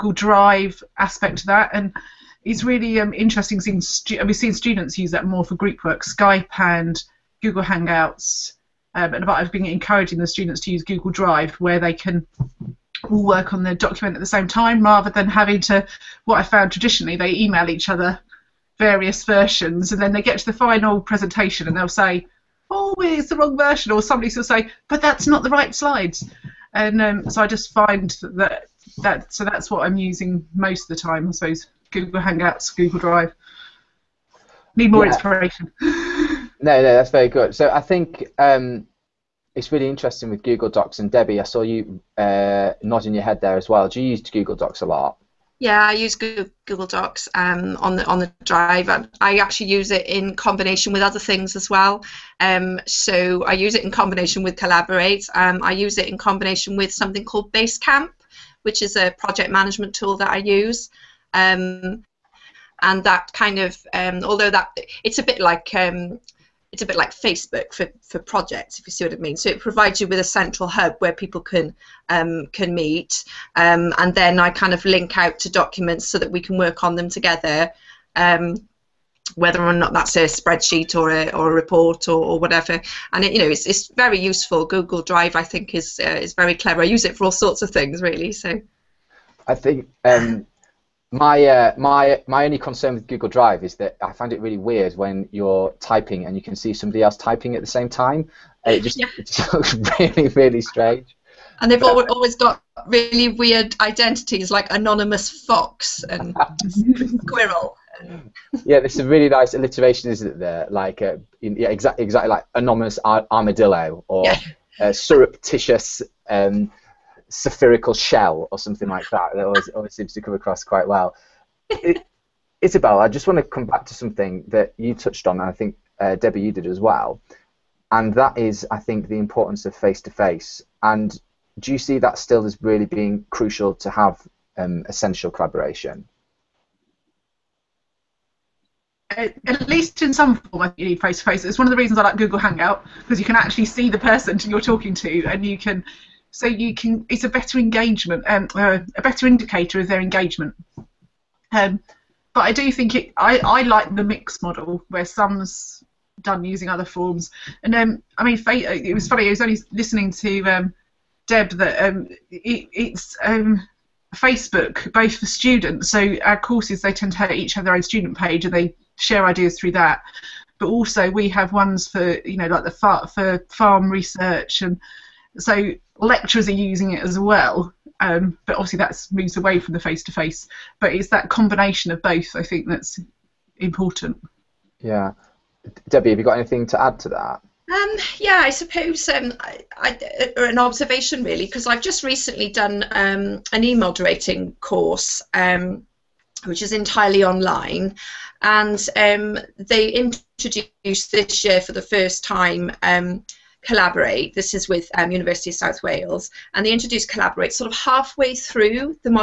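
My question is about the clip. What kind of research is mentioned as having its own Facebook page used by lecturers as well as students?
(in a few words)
farm research.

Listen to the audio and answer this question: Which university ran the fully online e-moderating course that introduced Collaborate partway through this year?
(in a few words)
University of South Wales.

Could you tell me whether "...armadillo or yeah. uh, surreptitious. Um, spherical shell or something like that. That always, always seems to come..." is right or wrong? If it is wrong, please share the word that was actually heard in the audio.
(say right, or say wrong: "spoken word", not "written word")
right.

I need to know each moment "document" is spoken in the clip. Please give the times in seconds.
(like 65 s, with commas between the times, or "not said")
13 s, 75 s.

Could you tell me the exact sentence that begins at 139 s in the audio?
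Uh, at least in some form, you need face to face.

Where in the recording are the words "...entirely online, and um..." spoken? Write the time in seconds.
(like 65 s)
196 s.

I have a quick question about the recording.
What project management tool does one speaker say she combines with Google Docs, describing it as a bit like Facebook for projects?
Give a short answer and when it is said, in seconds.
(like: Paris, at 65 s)
Basecamp, at 57 s.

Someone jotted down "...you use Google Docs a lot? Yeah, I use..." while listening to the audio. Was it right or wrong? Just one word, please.
right.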